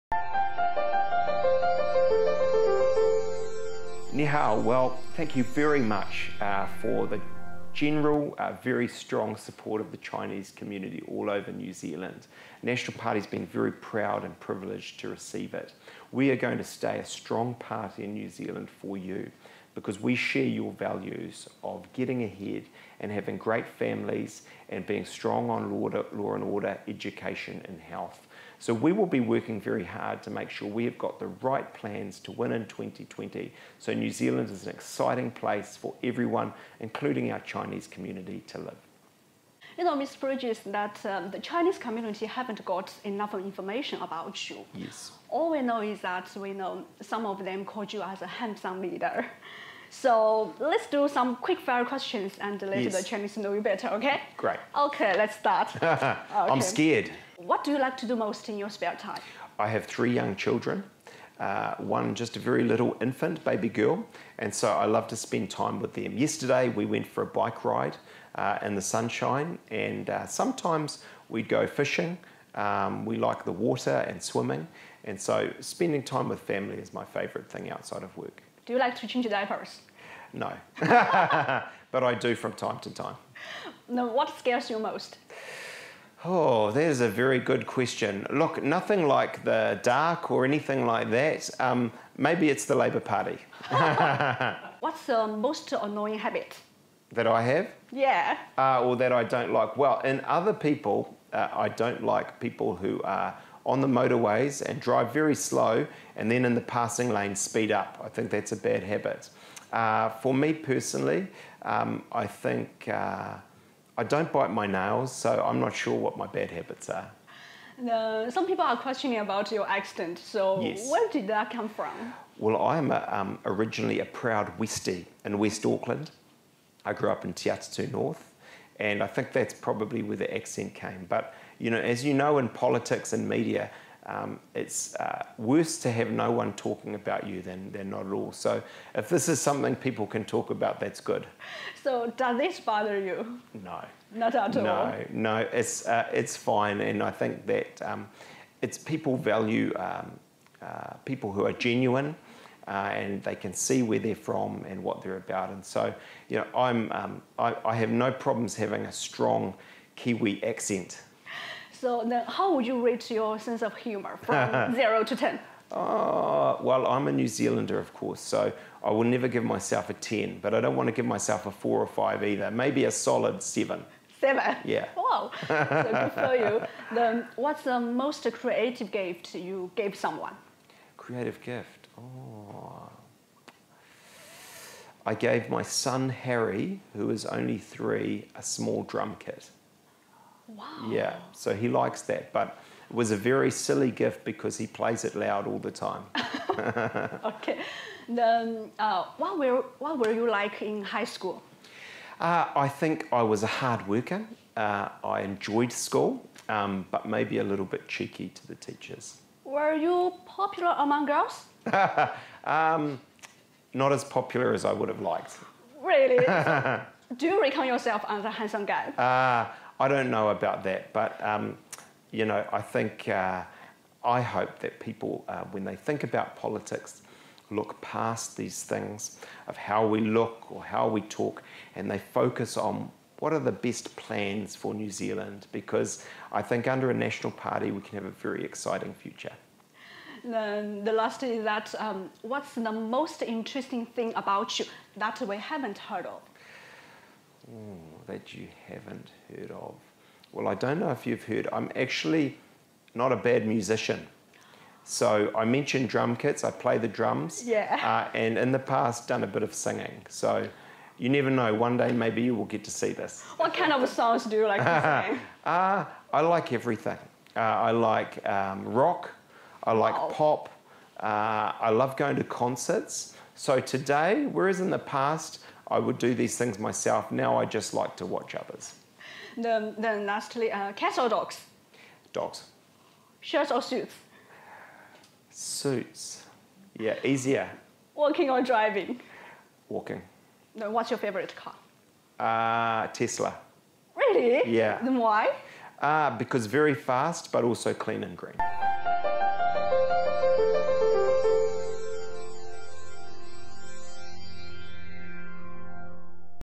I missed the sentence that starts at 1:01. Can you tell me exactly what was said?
Uh, one just a very little infant, baby girl, and so I love to spend time with them.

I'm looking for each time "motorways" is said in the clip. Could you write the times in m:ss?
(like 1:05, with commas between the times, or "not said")
1:43.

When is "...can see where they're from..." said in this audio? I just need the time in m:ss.
2:33.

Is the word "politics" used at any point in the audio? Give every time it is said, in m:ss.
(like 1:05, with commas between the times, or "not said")
2:12, 3:46.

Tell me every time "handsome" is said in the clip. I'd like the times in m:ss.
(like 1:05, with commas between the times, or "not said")
0:48, 3:38.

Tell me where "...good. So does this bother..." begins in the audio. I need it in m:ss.
2:20.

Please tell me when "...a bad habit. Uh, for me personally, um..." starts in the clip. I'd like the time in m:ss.
1:48.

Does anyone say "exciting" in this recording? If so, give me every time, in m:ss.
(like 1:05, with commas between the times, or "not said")
0:34, 3:58.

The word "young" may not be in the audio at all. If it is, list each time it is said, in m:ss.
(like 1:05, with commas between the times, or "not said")
1:00.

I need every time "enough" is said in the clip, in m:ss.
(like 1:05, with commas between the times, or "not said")
0:43.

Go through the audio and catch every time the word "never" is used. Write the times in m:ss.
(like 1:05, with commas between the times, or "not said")
2:49, 4:21.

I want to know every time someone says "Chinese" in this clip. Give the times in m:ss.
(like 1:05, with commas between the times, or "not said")
0:09, 0:37, 0:41, 0:53.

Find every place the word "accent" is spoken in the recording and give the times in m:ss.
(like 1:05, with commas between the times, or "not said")
1:59, 2:10, 2:40.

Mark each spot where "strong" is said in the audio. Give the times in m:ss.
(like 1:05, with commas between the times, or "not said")
0:08, 0:17, 0:25, 2:38.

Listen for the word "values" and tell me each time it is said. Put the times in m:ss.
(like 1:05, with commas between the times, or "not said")
0:20, 2:29.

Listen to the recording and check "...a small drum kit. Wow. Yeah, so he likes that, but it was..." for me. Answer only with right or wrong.
right.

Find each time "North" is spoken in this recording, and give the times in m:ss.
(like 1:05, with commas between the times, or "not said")
2:07.